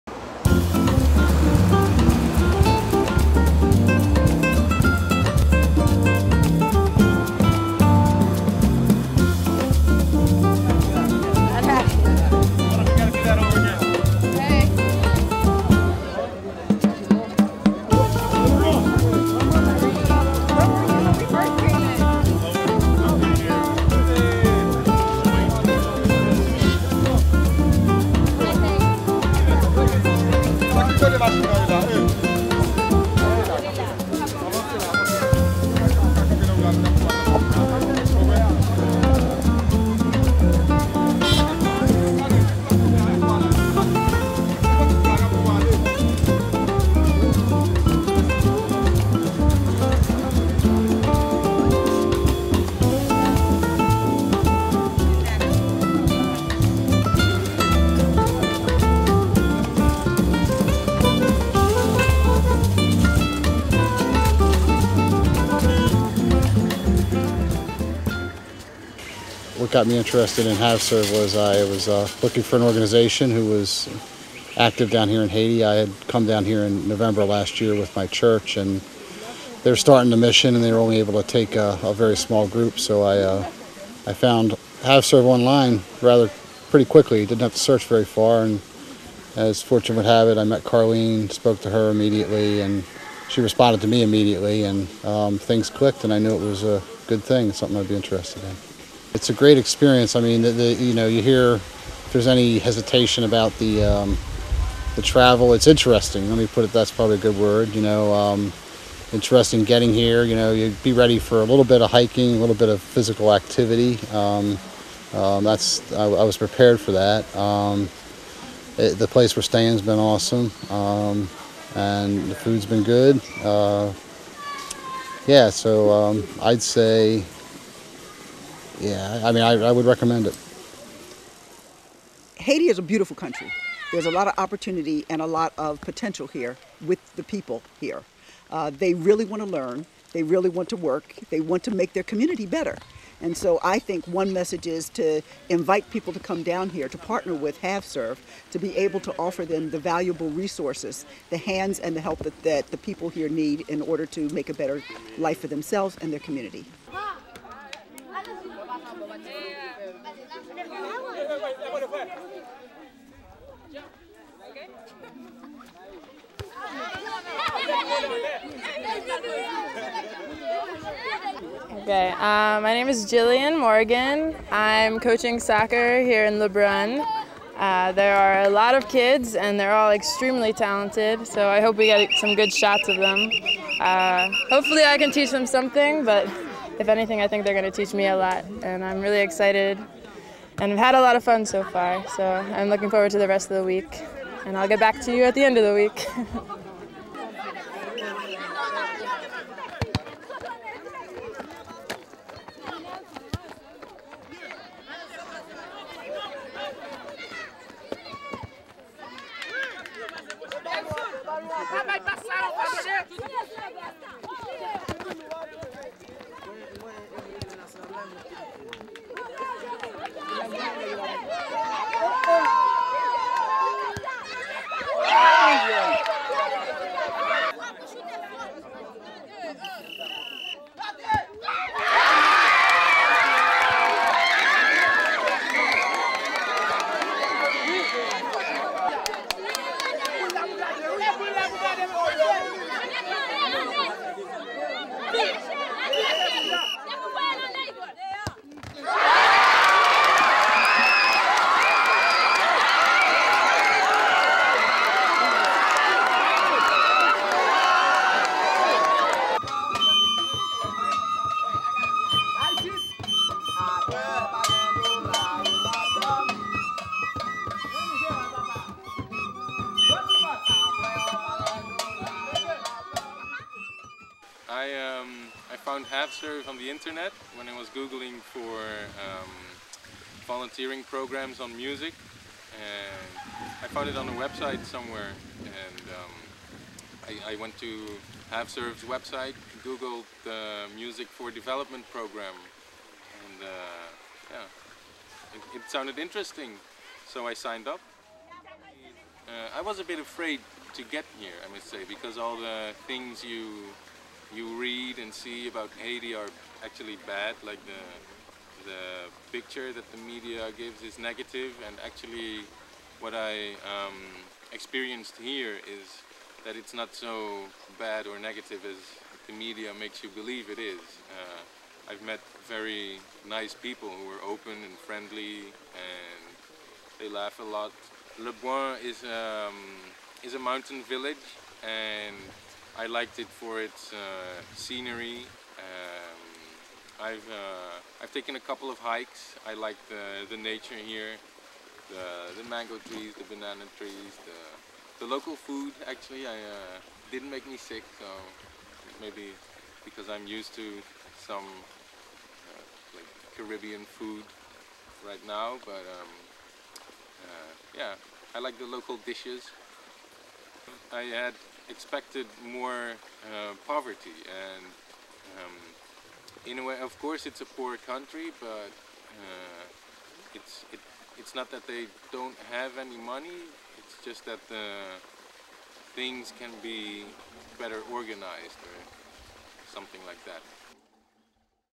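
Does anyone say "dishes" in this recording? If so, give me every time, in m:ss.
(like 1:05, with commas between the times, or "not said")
5:58.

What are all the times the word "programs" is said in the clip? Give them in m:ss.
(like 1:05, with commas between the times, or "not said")
4:40, 4:51.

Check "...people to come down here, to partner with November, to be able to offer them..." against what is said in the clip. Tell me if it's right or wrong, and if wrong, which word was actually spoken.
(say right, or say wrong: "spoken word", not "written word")
wrong: "HavServe", not "November".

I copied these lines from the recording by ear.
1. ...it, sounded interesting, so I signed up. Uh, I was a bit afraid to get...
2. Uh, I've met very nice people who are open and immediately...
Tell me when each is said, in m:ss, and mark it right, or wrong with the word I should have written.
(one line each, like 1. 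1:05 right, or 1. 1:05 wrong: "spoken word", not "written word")
1. 4:55 right
2. 5:21 wrong: "friendly", not "immediately".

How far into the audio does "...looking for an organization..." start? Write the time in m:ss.
1:12.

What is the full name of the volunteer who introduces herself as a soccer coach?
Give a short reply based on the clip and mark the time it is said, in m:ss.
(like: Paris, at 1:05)
Jillian Morgan, at 2:53.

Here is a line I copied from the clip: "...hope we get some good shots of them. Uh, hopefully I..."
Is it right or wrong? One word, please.
right.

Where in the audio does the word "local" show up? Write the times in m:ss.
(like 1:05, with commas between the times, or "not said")
5:45, 5:58.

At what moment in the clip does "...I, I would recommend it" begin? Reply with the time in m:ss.
2:09.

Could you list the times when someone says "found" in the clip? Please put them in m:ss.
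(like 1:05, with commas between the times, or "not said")
1:24, 4:35, 4:43.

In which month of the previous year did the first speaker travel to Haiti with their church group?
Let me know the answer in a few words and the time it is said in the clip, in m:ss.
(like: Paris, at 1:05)
November, at 1:16.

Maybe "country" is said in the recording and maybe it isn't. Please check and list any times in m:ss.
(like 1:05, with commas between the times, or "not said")
2:13, 6:07.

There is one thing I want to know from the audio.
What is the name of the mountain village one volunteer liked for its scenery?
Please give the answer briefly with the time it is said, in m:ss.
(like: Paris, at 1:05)
Le Bois, at 5:28.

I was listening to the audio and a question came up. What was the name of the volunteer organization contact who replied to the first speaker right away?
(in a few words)
Carlene.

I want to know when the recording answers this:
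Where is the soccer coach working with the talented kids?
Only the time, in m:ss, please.
2:56.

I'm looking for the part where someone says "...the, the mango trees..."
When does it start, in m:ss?
5:41.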